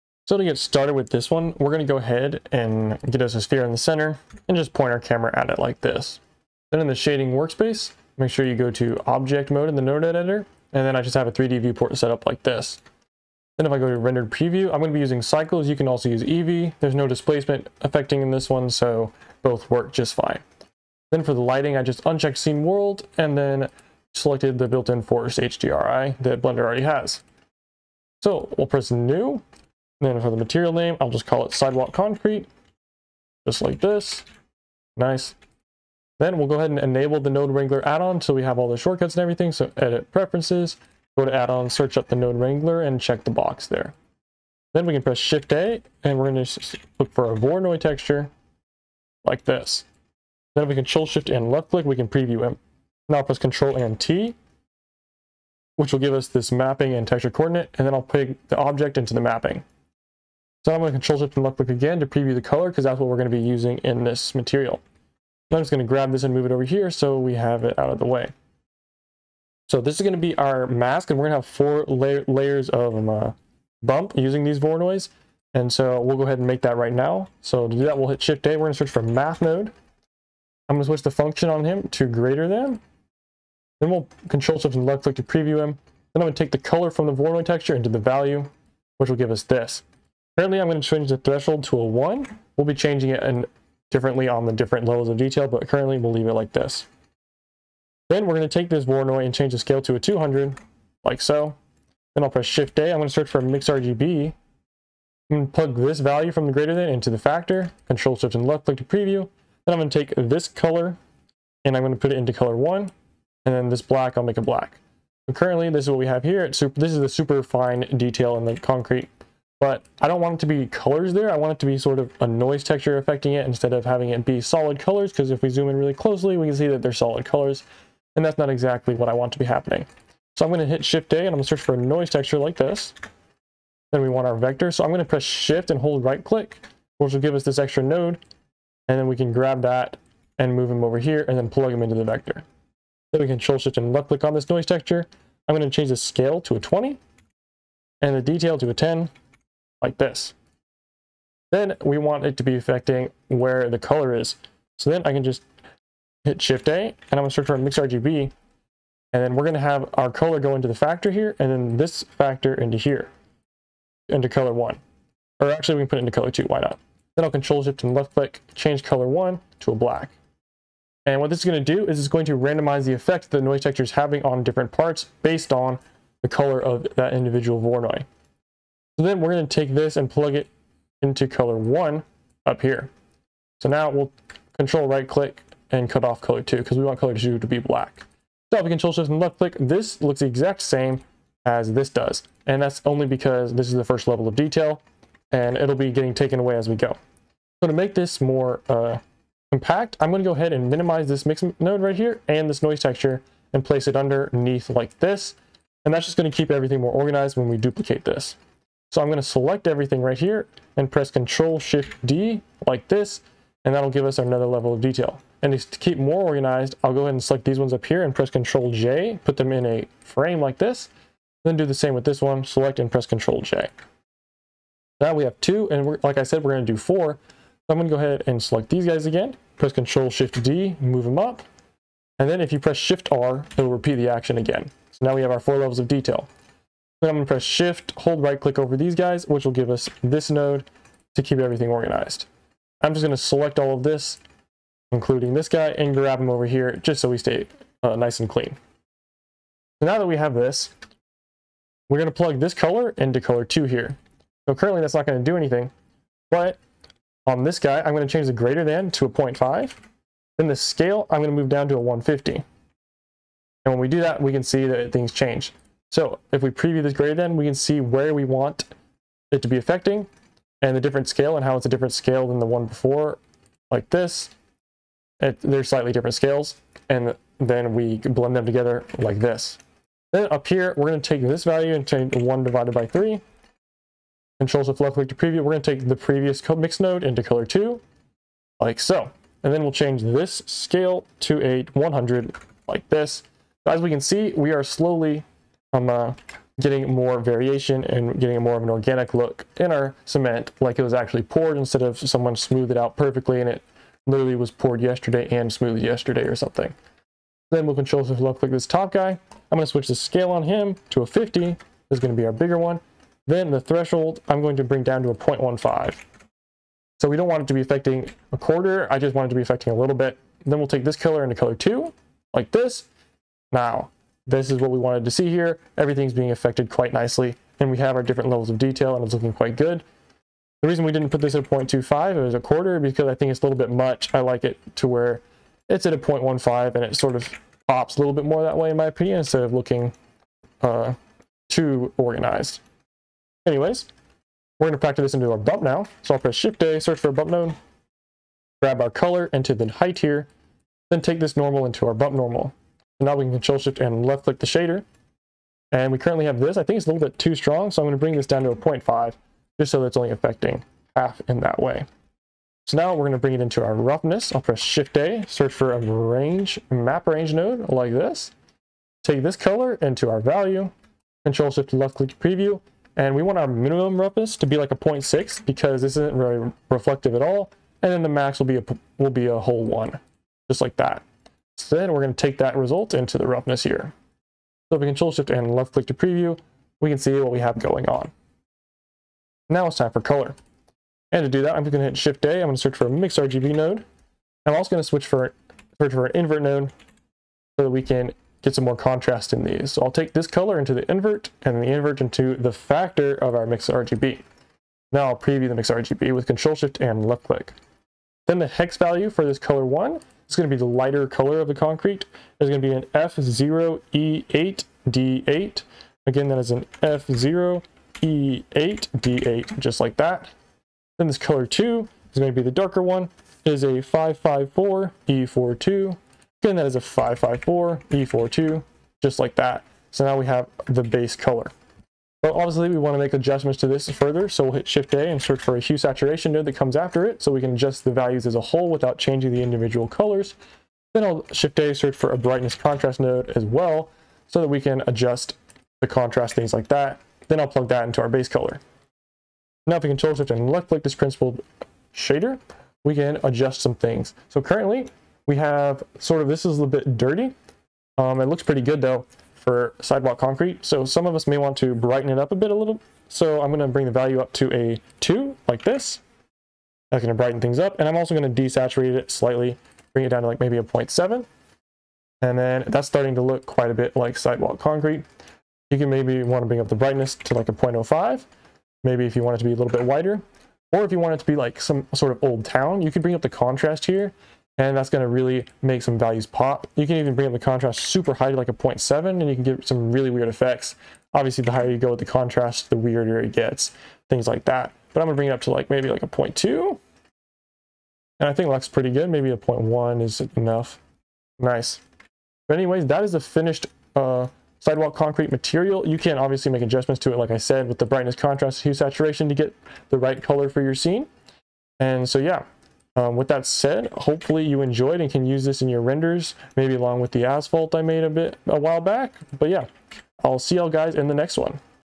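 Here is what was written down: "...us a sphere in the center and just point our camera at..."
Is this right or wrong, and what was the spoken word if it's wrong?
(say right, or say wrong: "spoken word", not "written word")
right.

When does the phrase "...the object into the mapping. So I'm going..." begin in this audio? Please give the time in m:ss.
0:58.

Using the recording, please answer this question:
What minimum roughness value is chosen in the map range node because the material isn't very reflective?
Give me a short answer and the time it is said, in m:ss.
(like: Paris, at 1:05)
0.6, at 6:14.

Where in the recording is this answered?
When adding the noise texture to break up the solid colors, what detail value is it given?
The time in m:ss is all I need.
2:28.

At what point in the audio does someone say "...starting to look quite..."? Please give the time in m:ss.
7:52.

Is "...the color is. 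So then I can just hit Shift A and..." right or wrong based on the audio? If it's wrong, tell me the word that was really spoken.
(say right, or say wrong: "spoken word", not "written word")
right.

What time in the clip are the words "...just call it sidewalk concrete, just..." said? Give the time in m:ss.
0:31.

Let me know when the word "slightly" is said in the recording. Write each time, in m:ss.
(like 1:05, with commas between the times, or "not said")
4:35, 7:49.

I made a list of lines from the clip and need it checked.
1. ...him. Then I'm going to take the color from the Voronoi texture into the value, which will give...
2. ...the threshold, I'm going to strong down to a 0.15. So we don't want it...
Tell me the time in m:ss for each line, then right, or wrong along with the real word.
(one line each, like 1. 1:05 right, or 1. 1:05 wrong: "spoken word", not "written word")
1. 1:25 right
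2. 5:13 wrong: "bring", not "strong".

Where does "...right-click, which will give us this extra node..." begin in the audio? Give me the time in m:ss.
2:16.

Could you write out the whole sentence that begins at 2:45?
Or actually we can put it into color two, why not?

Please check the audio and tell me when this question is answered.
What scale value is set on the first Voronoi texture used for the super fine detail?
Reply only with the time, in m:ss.
1:39.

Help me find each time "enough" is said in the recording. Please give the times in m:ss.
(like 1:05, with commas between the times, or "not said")
8:20.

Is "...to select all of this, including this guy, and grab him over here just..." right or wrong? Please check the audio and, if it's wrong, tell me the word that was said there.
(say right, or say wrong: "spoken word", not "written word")
right.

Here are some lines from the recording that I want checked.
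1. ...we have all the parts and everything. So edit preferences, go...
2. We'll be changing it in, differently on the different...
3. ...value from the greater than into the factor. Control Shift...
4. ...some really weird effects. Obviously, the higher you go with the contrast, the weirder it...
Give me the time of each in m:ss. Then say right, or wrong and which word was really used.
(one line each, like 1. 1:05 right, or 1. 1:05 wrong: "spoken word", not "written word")
1. 0:38 wrong: "shortcuts", not "parts"
2. 1:32 right
3. 1:45 right
4. 8:09 right.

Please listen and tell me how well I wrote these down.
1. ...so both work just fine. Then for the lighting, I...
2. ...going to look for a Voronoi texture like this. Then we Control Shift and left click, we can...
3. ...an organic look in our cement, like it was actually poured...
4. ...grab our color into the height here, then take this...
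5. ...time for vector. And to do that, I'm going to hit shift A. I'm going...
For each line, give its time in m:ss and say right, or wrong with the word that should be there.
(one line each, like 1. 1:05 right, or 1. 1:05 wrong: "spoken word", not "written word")
1. 0:18 right
2. 0:46 right
3. 4:58 right
4. 5:48 right
5. 6:29 wrong: "color", not "vector".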